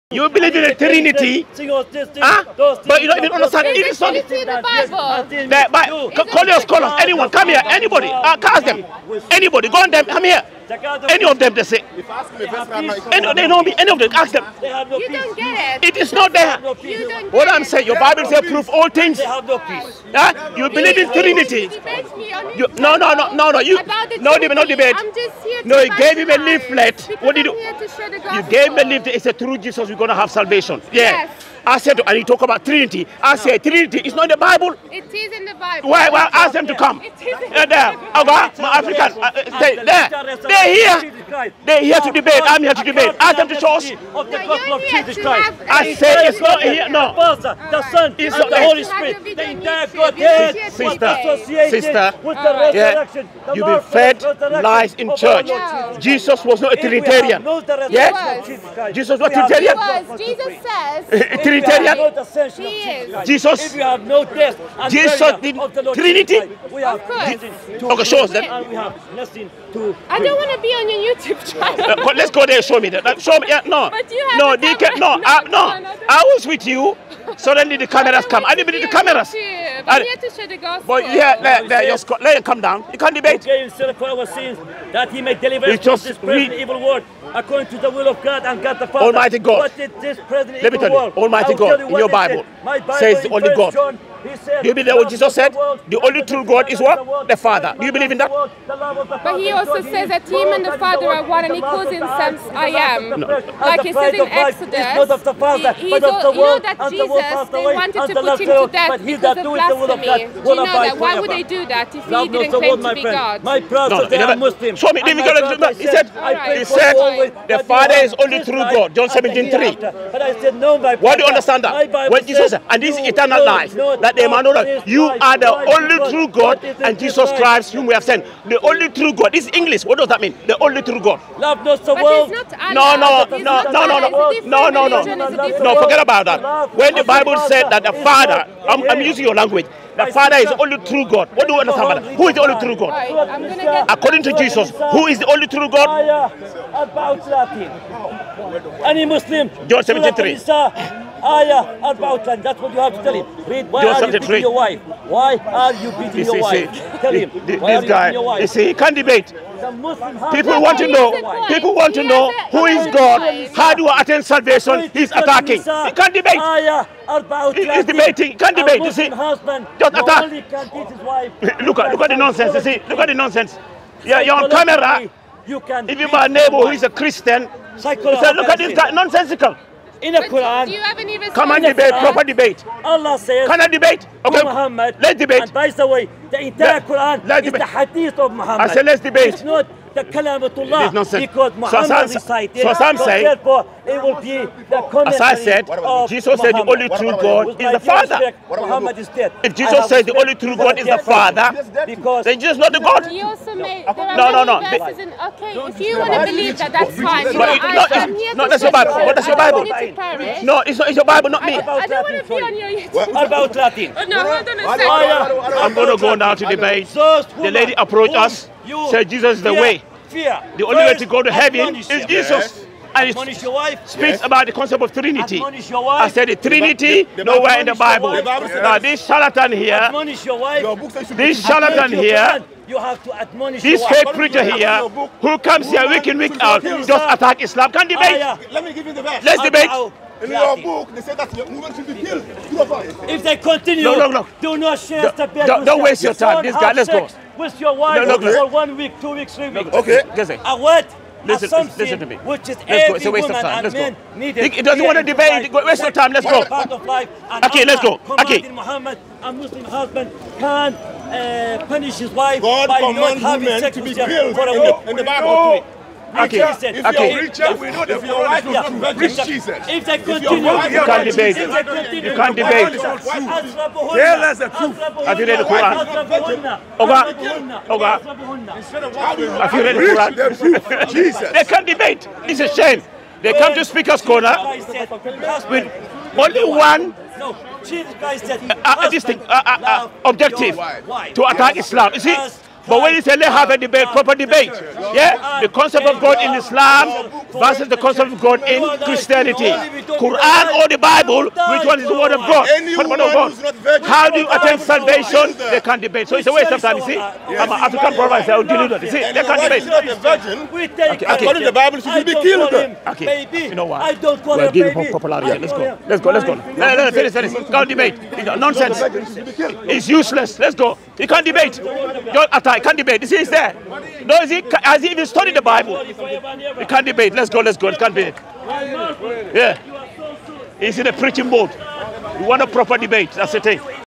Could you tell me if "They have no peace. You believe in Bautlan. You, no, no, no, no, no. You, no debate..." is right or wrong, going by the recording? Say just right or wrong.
wrong.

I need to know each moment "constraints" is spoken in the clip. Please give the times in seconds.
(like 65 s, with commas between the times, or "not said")
not said.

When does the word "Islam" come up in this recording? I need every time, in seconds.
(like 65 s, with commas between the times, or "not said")
237 s, 291 s, 296 s.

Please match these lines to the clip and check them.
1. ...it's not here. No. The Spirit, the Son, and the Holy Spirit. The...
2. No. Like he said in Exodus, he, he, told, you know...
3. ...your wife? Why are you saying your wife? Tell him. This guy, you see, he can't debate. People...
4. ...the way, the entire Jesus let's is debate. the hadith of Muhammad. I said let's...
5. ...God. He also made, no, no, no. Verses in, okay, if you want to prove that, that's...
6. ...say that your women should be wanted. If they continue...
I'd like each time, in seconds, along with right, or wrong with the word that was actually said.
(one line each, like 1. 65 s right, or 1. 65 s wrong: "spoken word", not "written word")
1. 46 s wrong: "Father", not "Spirit"
2. 103 s right
3. 154 s wrong: "beating", not "saying"
4. 185 s wrong: "Quran", not "Jesus"
5. 202 s wrong: "believe", not "prove"
6. 241 s wrong: "killed", not "wanted".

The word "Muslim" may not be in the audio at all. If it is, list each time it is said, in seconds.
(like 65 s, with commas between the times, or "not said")
114 s, 149 s, 259 s.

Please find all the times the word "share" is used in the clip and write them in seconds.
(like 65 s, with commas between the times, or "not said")
80 s, 244 s.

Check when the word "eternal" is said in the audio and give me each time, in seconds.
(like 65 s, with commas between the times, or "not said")
123 s.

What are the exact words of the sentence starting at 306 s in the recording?
So it's a waste of time, you see?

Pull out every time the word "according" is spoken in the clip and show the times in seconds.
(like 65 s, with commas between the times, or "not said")
87 s, 143 s, 311 s.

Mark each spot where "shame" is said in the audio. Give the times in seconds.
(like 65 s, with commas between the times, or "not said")
282 s.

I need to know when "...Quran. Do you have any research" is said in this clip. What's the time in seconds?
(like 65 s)
180 s.